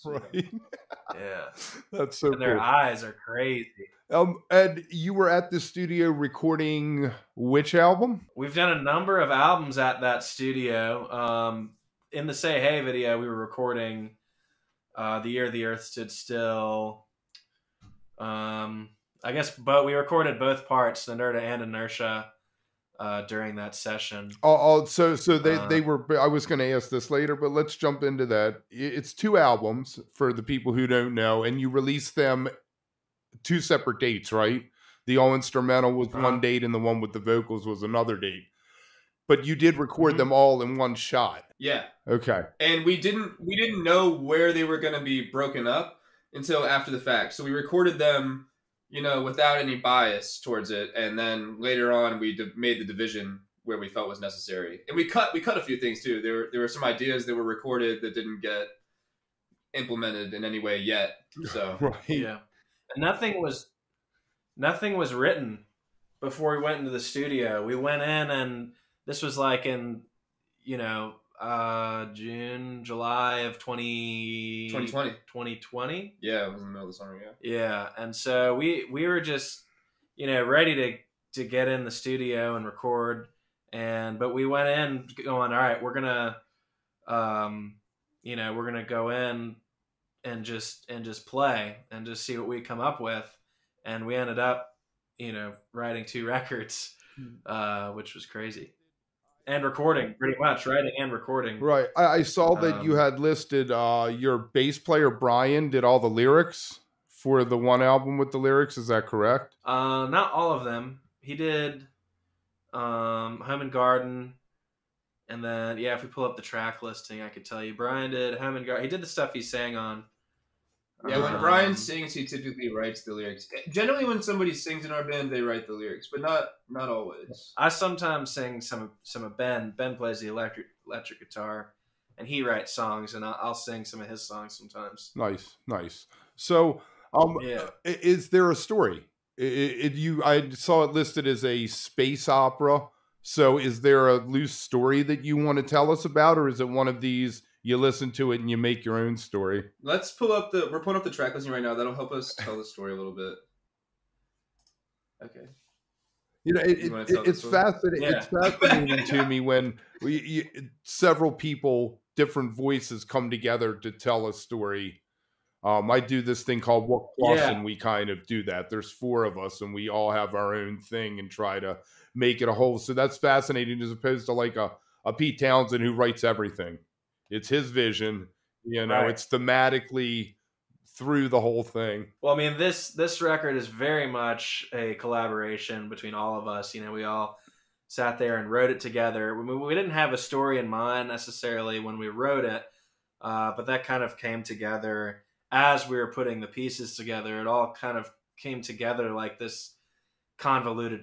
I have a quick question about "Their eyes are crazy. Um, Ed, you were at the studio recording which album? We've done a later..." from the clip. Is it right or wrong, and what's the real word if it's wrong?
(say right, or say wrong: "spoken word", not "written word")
wrong: "number", not "later".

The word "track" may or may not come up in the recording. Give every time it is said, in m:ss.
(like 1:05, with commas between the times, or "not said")
1:56, 2:31.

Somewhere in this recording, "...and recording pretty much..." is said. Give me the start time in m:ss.
1:39.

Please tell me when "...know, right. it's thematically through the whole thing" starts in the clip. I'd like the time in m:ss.
2:58.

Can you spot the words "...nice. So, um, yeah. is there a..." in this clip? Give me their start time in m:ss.
2:15.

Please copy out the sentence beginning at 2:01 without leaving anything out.
Brian sings, he typically writes the lyrics.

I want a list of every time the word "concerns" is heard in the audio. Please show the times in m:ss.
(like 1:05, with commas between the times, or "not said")
not said.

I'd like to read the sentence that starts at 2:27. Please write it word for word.
you listen to it and you make your own story.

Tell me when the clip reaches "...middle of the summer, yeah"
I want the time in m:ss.
1:16.